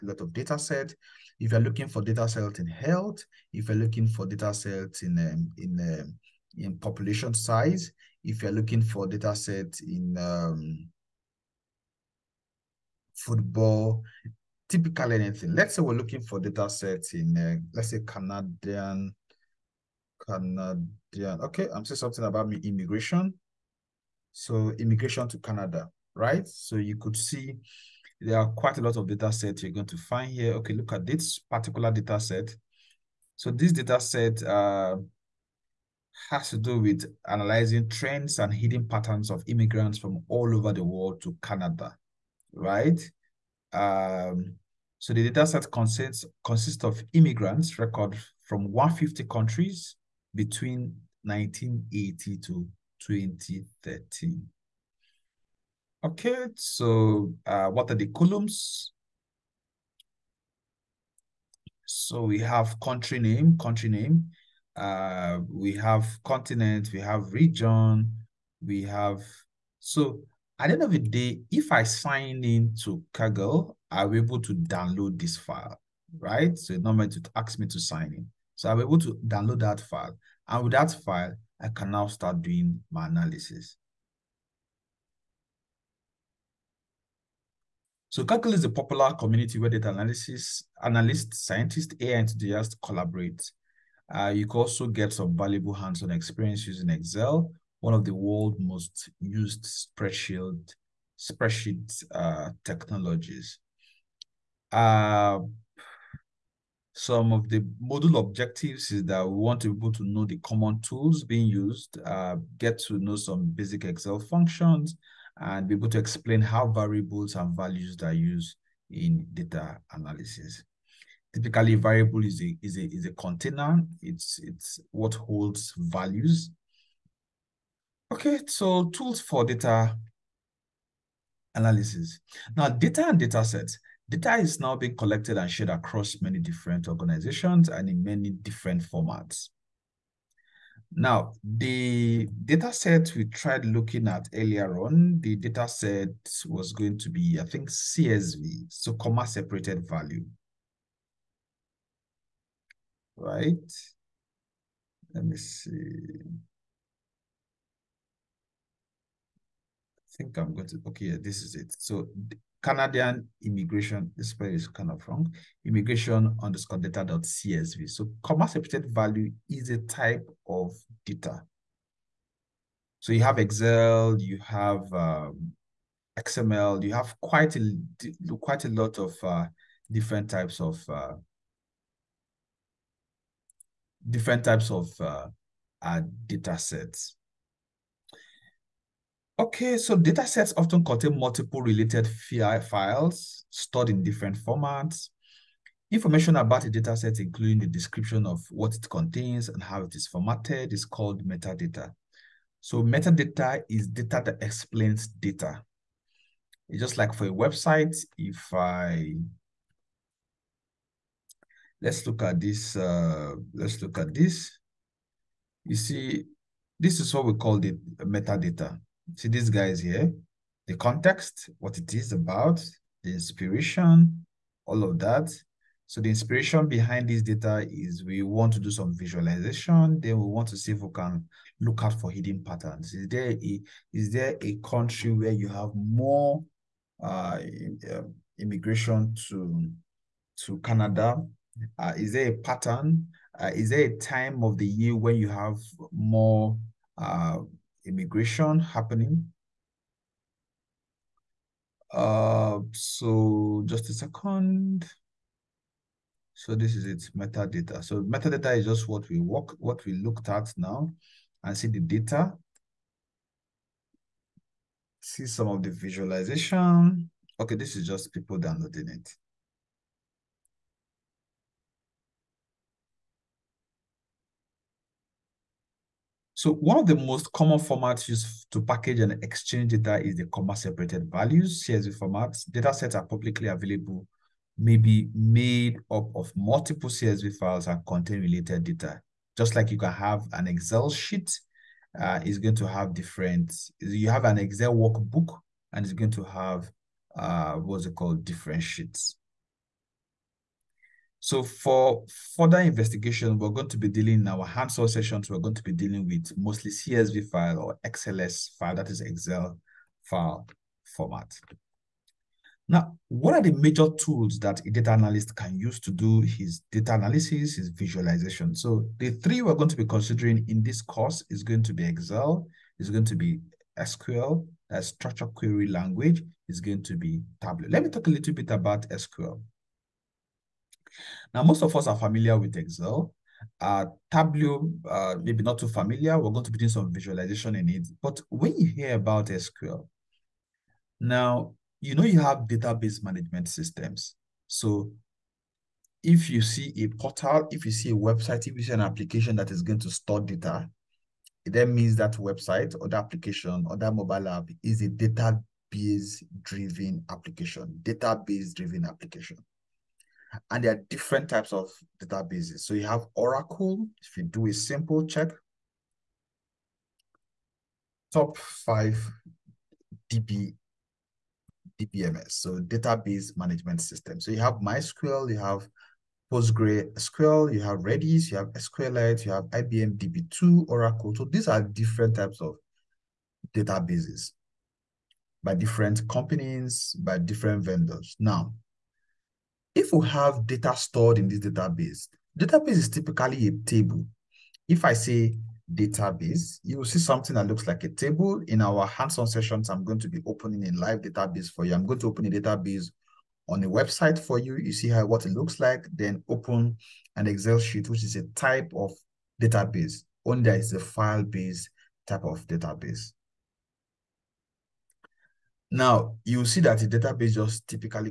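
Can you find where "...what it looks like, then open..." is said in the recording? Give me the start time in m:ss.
6:45.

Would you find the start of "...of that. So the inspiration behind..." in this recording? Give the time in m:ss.
3:44.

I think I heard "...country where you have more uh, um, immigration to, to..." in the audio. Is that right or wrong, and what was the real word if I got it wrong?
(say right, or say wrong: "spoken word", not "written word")
right.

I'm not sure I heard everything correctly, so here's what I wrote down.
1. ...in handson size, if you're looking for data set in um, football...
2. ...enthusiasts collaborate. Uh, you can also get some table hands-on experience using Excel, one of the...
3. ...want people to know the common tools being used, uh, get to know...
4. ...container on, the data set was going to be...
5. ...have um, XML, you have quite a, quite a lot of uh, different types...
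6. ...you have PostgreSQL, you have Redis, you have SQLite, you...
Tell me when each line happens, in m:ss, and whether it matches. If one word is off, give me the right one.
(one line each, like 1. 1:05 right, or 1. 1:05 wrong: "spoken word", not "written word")
1. 0:06 wrong: "population", not "handson"
2. 1:32 wrong: "valuable", not "table"
3. 1:49 right
4. 2:24 wrong: "earlier", not "container"
5. 2:54 right
6. 6:15 right.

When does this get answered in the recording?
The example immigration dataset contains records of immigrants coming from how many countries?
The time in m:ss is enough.
0:48.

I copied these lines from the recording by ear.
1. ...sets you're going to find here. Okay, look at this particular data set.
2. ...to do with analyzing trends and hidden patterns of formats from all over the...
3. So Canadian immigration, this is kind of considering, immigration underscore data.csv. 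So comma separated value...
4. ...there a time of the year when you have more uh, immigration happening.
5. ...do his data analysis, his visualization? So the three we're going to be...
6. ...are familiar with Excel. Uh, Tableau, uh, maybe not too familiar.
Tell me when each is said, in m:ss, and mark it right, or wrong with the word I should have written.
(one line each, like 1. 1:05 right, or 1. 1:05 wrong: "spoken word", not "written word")
1. 0:29 right
2. 0:36 wrong: "immigrants", not "formats"
3. 2:41 wrong: "wrong", not "considering"
4. 4:03 right
5. 5:15 right
6. 5:31 right.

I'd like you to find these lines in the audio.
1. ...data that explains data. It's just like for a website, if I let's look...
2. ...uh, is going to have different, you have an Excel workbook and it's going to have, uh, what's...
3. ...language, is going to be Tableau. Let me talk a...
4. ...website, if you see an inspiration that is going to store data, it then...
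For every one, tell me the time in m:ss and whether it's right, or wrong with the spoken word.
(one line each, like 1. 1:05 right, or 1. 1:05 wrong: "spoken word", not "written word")
1. 3:23 right
2. 4:51 right
3. 5:25 right
4. 5:47 wrong: "application", not "inspiration".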